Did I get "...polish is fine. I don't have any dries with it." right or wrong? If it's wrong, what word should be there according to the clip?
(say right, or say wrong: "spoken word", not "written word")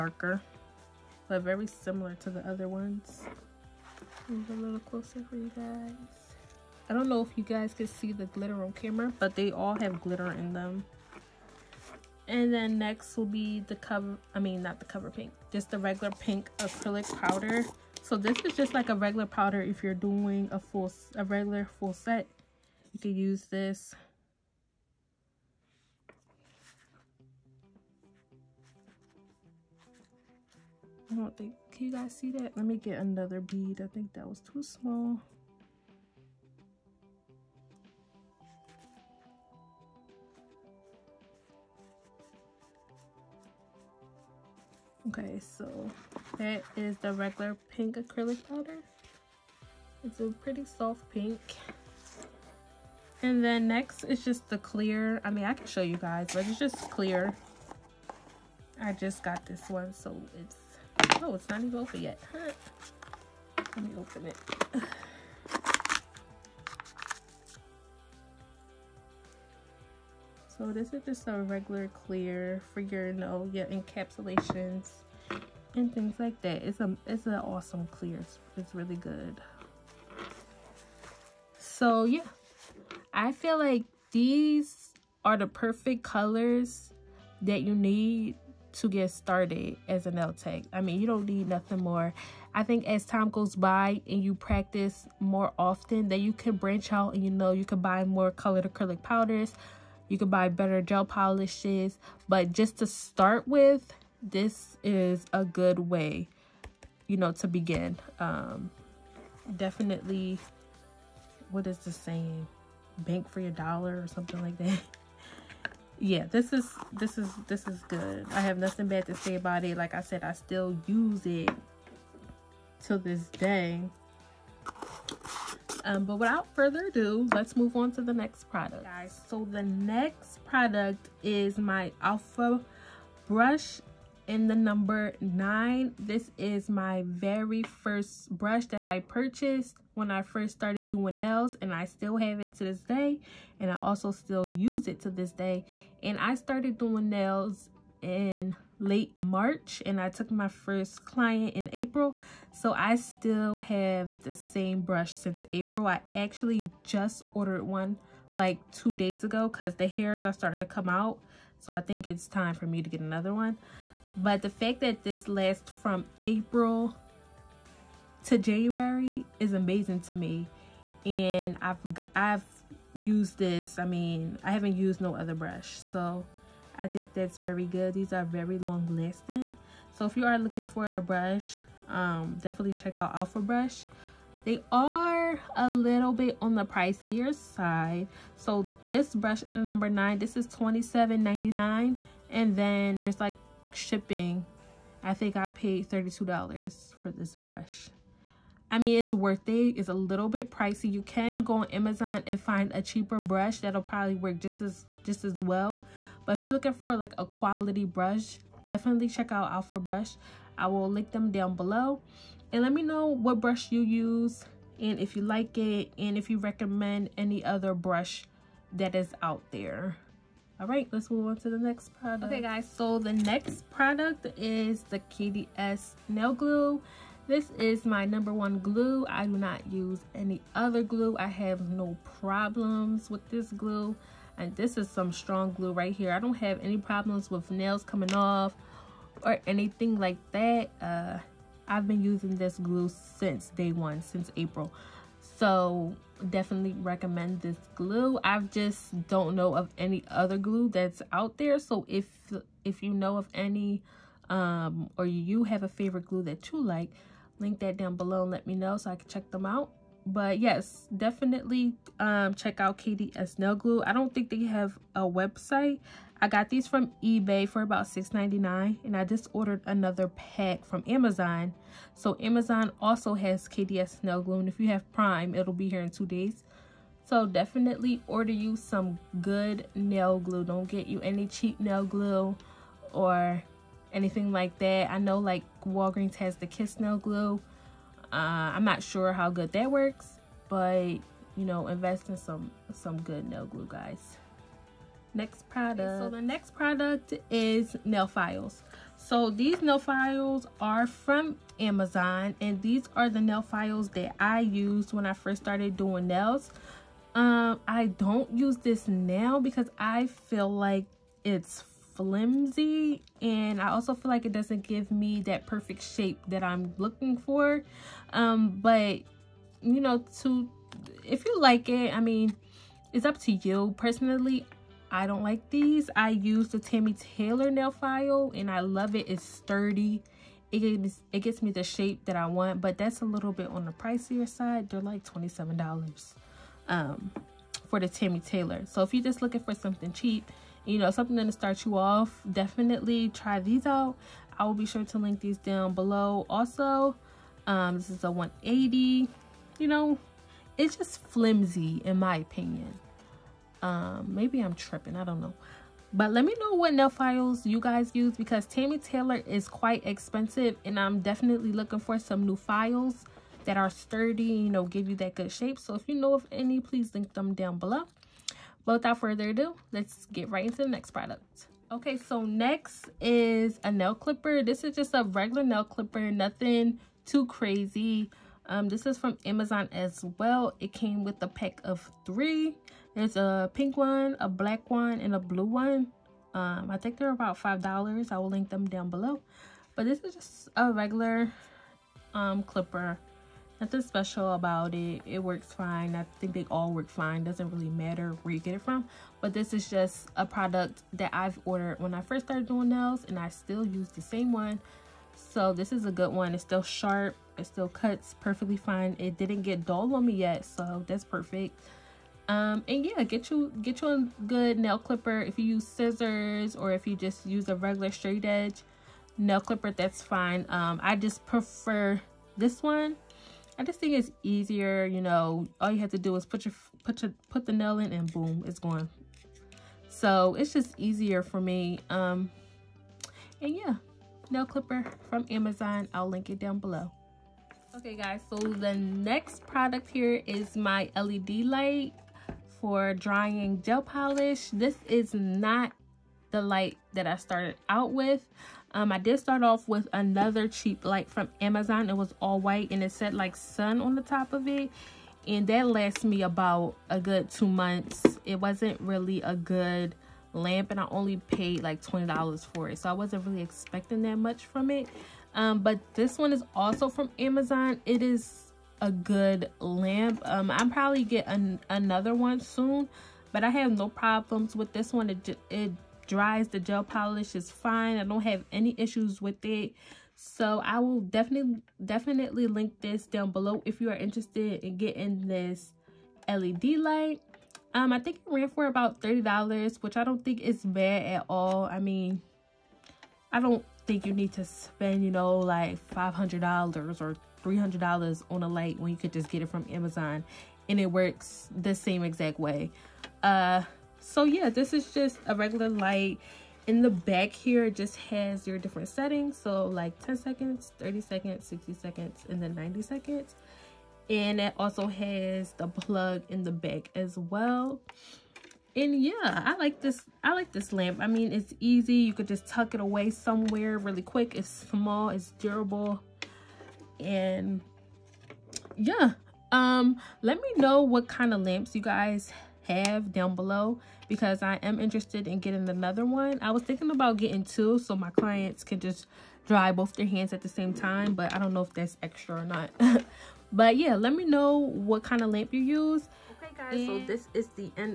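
wrong: "issues", not "dries".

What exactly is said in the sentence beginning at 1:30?
I mean, you don't need nothing more.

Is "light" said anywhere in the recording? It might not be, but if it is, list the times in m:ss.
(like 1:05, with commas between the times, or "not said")
7:21, 7:26, 7:30, 8:06, 8:18, 8:25.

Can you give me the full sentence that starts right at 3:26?
But if you're looking for like a quality brush, definitely check out Alpha Brush.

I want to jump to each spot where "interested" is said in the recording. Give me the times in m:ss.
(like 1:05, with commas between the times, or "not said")
8:03, 8:54.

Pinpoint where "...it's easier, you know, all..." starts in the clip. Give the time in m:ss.
7:03.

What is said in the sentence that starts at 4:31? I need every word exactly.
So Amazon also has KDS Nail Glue and if you have Prime, it'll be here in two days.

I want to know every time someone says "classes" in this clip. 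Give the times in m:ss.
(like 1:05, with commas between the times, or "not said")
not said.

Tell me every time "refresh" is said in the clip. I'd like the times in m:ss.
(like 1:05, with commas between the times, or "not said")
not said.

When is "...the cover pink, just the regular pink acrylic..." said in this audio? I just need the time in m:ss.
0:14.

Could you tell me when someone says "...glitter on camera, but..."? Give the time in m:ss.
0:08.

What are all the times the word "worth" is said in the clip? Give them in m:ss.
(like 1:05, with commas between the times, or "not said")
3:19.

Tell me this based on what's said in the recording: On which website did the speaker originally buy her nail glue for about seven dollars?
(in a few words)
eBay.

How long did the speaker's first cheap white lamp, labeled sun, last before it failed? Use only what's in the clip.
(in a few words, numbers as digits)
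2 months.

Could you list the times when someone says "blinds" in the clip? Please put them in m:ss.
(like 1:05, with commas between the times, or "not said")
not said.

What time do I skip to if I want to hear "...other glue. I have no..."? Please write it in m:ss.
3:50.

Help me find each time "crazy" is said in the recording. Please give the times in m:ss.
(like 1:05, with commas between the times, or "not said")
6:17.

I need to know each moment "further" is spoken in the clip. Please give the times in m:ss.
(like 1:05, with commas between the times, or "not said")
2:06, 6:08.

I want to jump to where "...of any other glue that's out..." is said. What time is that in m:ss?
4:09.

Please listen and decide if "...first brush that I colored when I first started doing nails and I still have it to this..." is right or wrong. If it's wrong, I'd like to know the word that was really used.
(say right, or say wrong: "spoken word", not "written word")
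wrong: "purchased", not "colored".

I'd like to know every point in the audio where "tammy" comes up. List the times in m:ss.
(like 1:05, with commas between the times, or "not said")
5:26, 5:37, 5:58.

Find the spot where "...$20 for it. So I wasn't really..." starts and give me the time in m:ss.
7:41.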